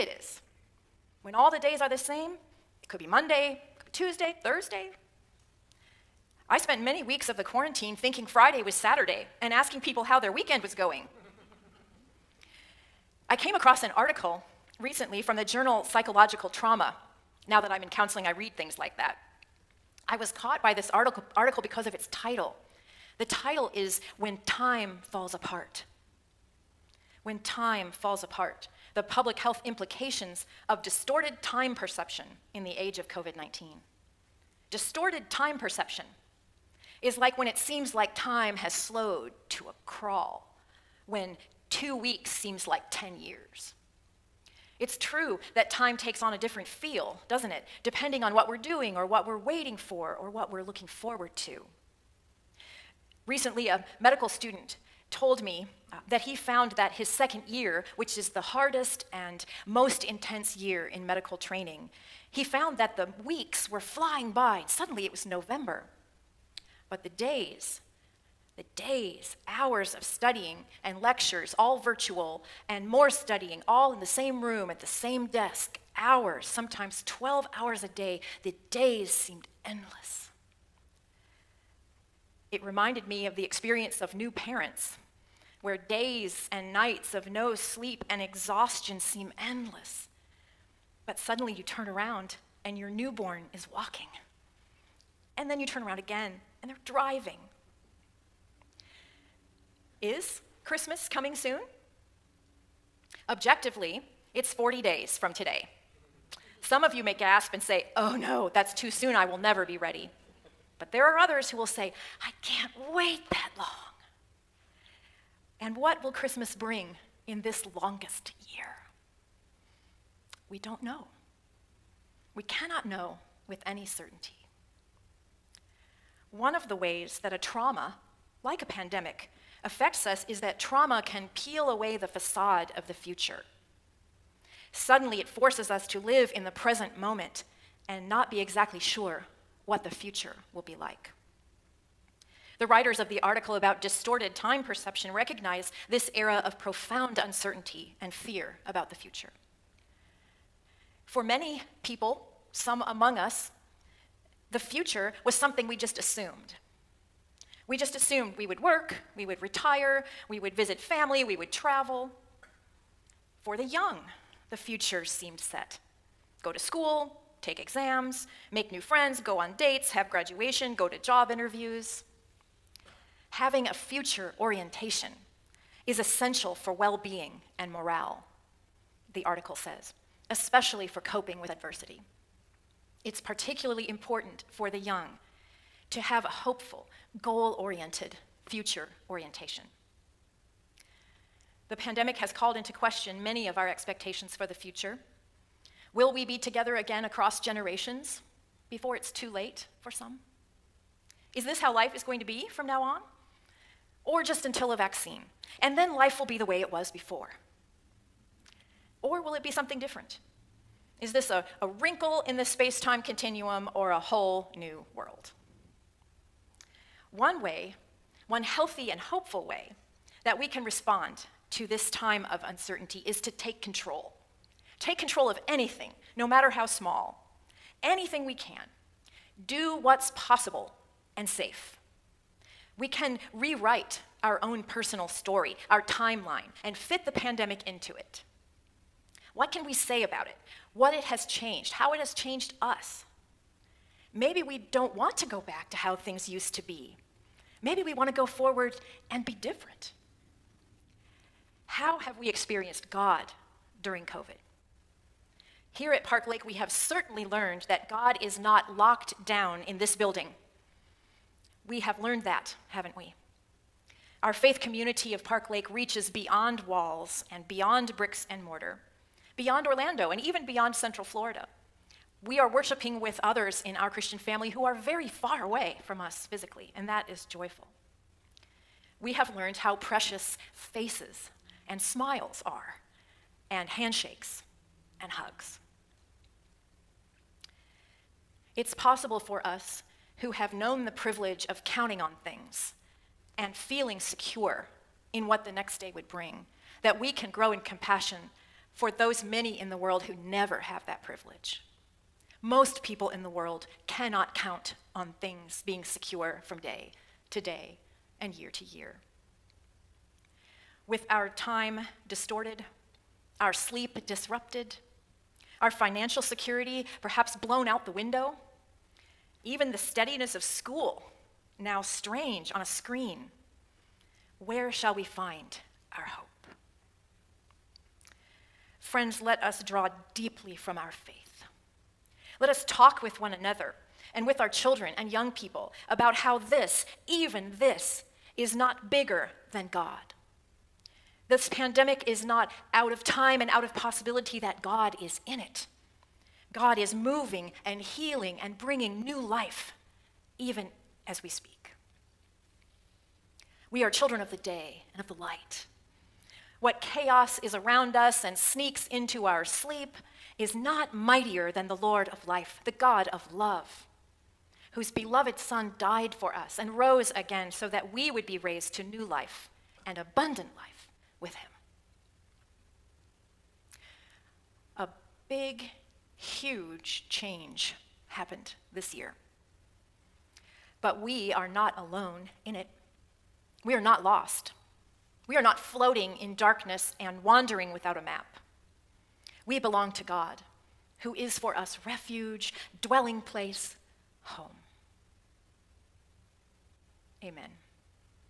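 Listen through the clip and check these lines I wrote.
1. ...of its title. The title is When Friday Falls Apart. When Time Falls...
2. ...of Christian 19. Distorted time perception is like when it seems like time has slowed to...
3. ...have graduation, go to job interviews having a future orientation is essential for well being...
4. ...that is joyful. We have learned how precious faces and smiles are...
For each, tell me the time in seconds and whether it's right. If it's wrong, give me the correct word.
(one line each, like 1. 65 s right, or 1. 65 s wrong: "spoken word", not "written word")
1. 21 s wrong: "Time", not "Friday"
2. 32 s wrong: "COVID", not "Christian"
3. 169 s right
4. 276 s right.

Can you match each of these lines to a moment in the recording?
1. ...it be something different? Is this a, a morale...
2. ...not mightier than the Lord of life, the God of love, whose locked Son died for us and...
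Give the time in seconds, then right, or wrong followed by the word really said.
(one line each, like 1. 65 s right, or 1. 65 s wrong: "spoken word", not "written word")
1. 209 s wrong: "wrinkle", not "morale"
2. 360 s wrong: "beloved", not "locked".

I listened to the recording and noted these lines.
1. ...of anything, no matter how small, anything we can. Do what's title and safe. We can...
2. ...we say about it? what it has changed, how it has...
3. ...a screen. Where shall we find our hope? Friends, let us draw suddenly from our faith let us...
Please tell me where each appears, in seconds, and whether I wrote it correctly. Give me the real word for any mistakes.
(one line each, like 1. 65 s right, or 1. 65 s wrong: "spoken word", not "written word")
1. 225 s wrong: "possible", not "title"
2. 239 s right
3. 322 s wrong: "deeply", not "suddenly".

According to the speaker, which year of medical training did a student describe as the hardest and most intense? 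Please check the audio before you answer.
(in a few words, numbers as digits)
second year.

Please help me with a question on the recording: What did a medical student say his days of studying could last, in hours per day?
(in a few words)
12 hours.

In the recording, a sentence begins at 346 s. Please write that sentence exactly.
God is moving and healing and bringing new life, even as we speak.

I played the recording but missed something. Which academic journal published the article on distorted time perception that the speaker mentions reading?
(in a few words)
Psychological Trauma.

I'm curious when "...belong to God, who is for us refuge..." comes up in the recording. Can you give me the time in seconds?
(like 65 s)
389 s.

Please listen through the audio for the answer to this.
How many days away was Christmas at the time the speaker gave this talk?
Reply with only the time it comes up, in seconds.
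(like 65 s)
104 s.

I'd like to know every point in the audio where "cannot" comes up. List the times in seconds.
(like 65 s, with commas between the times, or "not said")
122 s, 303 s.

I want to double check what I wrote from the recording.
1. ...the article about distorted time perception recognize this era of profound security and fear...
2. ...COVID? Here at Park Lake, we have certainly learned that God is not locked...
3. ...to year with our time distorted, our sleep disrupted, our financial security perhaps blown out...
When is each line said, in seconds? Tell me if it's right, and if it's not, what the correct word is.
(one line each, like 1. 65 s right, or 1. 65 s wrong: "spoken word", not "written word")
1. 143 s wrong: "uncertainty", not "security"
2. 254 s right
3. 308 s right.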